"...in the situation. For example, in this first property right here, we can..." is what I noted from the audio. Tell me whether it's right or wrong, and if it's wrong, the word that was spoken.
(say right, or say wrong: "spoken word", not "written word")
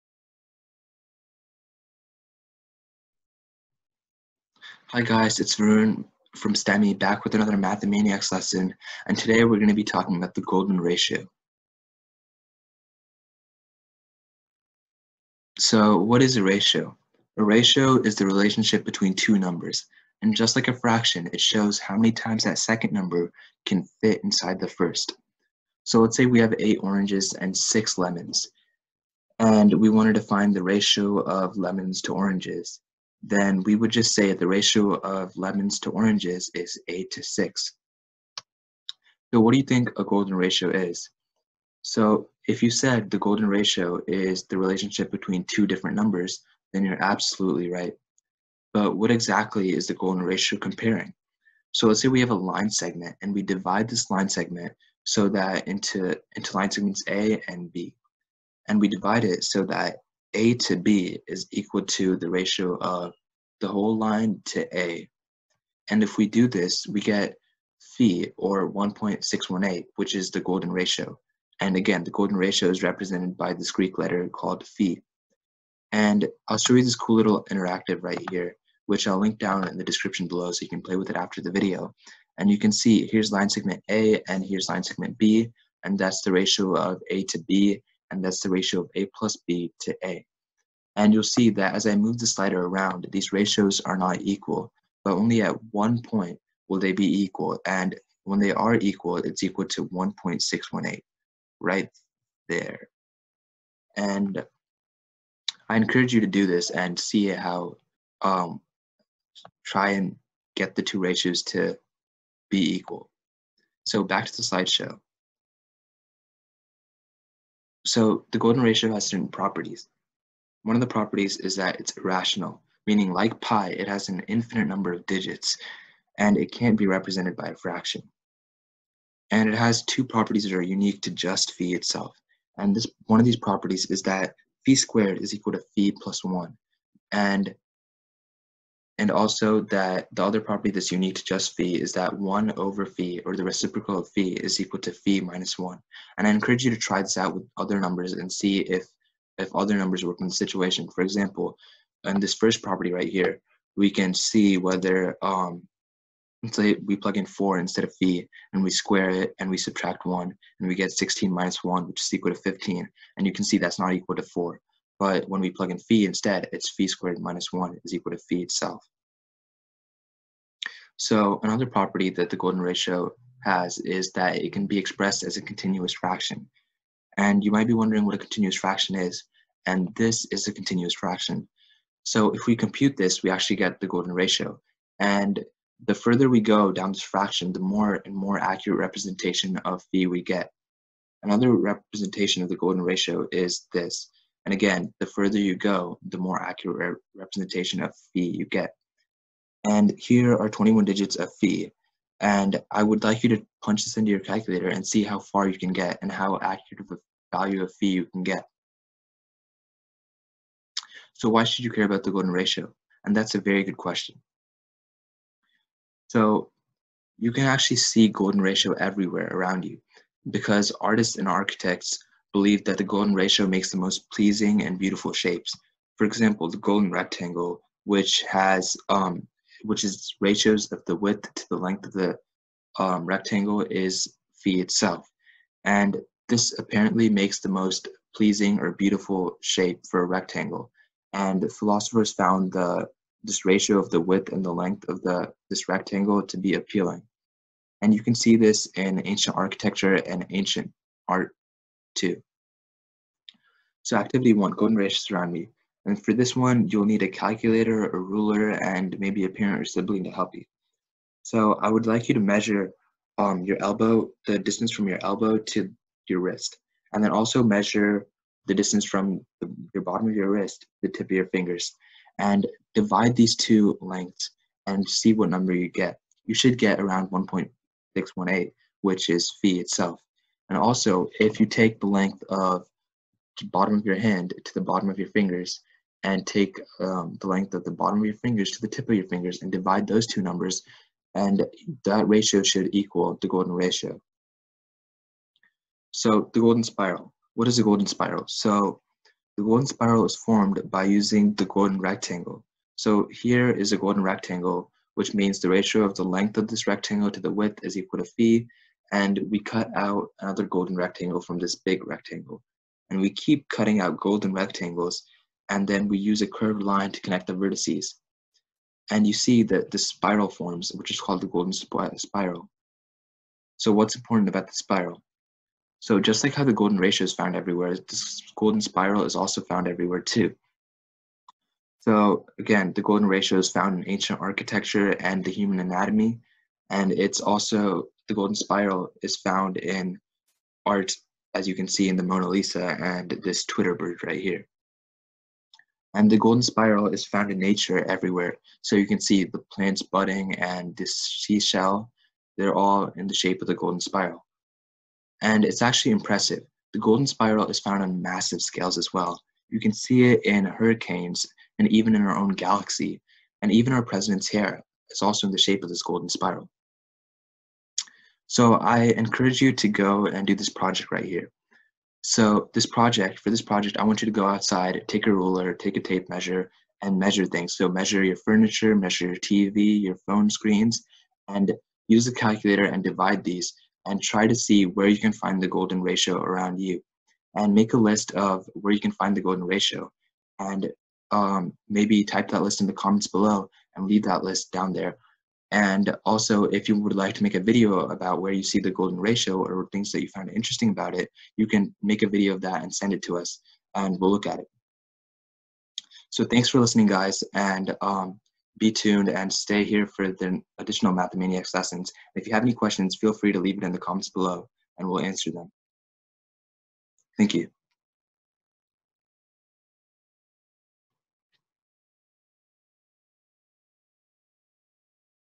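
right.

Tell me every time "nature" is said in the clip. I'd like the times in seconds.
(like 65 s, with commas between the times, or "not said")
347 s.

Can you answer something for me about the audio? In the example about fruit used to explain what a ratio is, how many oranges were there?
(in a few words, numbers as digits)
8.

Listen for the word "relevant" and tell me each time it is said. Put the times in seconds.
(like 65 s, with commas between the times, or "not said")
not said.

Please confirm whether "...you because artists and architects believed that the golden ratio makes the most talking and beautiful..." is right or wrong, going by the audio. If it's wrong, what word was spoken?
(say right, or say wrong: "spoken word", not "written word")
wrong: "pleasing", not "talking".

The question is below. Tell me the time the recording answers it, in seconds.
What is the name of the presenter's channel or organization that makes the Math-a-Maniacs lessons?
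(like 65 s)
6 s.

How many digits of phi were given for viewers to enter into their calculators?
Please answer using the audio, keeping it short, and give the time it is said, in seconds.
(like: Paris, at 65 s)
21, at 200 s.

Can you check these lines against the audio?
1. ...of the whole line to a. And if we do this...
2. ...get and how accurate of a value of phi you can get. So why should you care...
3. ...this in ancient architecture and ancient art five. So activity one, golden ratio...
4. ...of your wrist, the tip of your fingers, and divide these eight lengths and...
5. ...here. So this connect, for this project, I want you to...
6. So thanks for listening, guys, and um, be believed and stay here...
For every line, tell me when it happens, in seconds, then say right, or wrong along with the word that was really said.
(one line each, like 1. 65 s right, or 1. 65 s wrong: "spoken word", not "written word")
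1. 62 s right
2. 205 s right
3. 248 s wrong: "two", not "five"
4. 270 s wrong: "two", not "eight"
5. 371 s wrong: "project", not "connect"
6. 406 s wrong: "tuned", not "believed".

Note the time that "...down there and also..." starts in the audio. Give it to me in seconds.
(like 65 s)
394 s.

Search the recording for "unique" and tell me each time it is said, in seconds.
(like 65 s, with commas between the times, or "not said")
130 s, 140 s.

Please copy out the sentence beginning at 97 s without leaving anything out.
And when they are equal, it's equal to 1.618 right there.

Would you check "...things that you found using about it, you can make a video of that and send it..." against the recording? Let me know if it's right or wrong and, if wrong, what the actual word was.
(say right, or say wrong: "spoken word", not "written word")
wrong: "interesting", not "using".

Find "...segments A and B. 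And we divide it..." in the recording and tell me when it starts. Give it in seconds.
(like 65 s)
56 s.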